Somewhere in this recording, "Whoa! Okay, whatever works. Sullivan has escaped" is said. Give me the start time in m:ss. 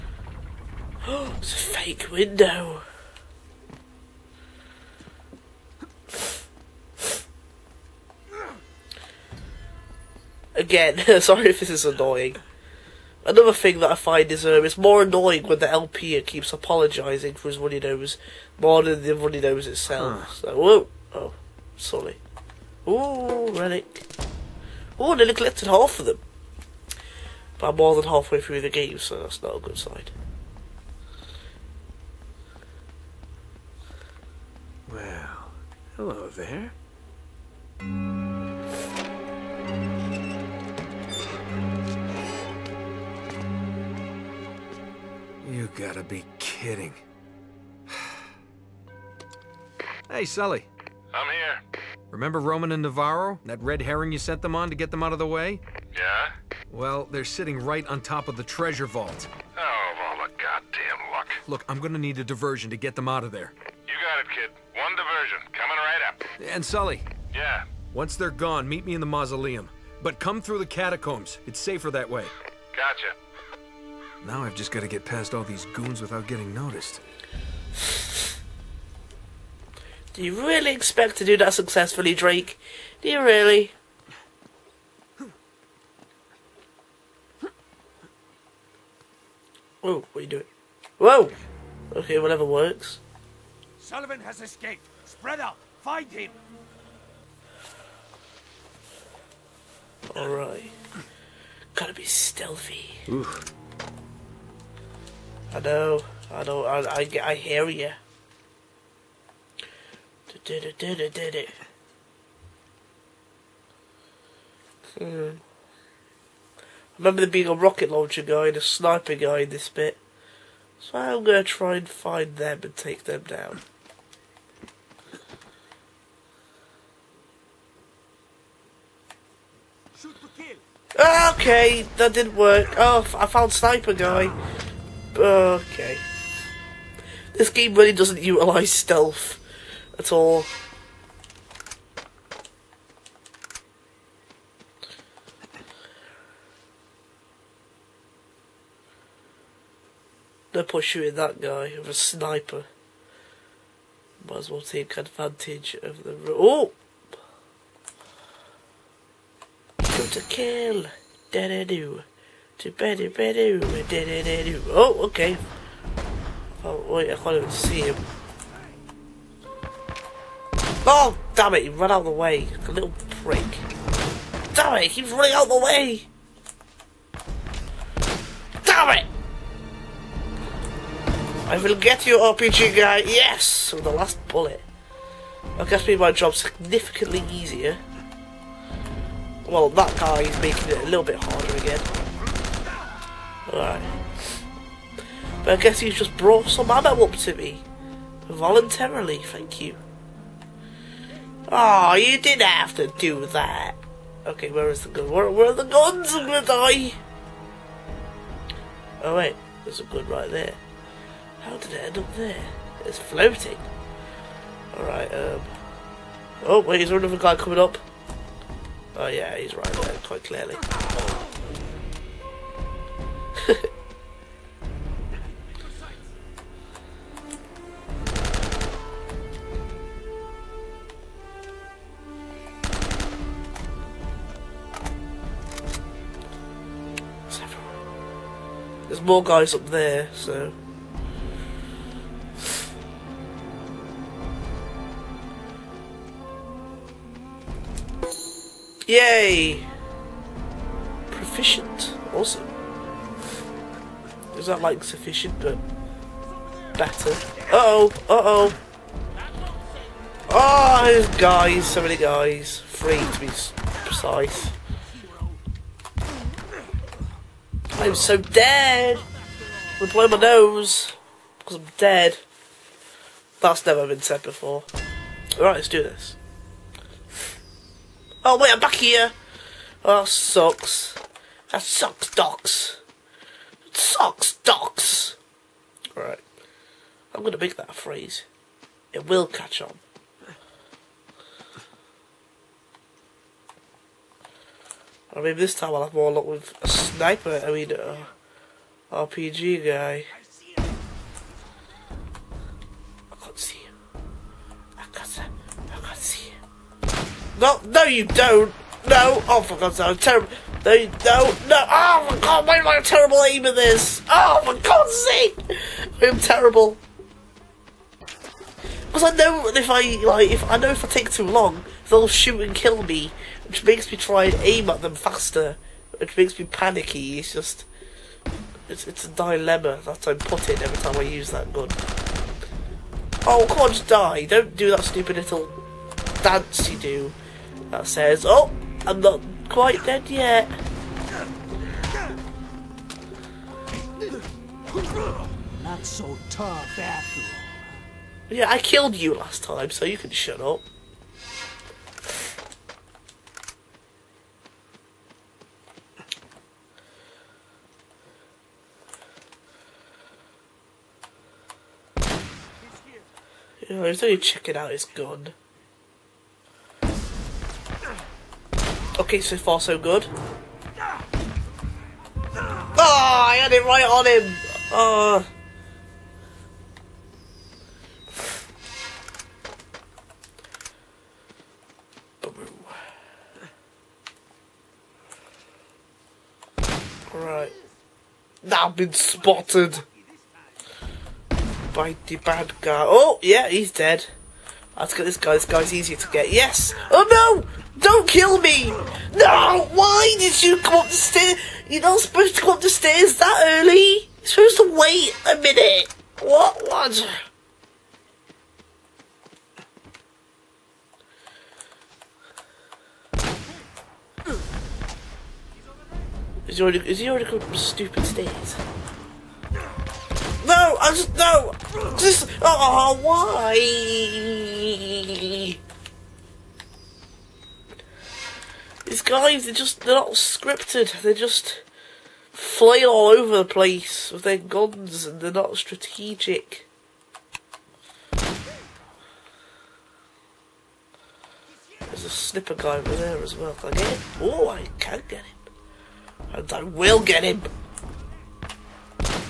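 1:30.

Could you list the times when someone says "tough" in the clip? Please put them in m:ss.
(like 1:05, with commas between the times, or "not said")
5:46.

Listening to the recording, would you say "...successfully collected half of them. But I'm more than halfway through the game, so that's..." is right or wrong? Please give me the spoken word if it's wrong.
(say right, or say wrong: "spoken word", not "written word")
wrong: "nearly", not "successfully".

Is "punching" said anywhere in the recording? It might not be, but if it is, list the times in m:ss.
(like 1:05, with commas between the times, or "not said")
not said.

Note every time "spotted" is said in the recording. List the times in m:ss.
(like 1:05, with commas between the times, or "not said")
6:28.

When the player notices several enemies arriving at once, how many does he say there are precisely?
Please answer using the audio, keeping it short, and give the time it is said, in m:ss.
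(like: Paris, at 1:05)
3, at 4:22.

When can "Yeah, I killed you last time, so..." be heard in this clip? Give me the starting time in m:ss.
5:48.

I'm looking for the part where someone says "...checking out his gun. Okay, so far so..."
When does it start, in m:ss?
6:04.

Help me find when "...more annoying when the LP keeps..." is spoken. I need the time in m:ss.
0:14.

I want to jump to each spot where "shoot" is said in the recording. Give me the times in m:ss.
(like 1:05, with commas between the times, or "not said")
5:22.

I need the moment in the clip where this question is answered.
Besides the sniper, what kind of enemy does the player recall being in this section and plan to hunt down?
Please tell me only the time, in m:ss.
1:57.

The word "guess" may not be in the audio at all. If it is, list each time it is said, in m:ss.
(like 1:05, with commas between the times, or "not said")
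3:05, 3:15.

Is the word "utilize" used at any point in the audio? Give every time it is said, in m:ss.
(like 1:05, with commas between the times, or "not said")
2:18.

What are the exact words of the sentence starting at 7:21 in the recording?
There's a snipper guy over there as well.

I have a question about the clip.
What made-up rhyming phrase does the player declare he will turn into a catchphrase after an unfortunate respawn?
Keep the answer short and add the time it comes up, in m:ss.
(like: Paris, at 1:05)
Socks, docs, at 4:43.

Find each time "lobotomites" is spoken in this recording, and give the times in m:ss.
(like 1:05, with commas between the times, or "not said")
not said.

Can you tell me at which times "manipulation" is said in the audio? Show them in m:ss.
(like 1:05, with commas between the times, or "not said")
not said.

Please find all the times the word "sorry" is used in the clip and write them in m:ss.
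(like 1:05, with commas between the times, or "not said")
0:11, 0:21.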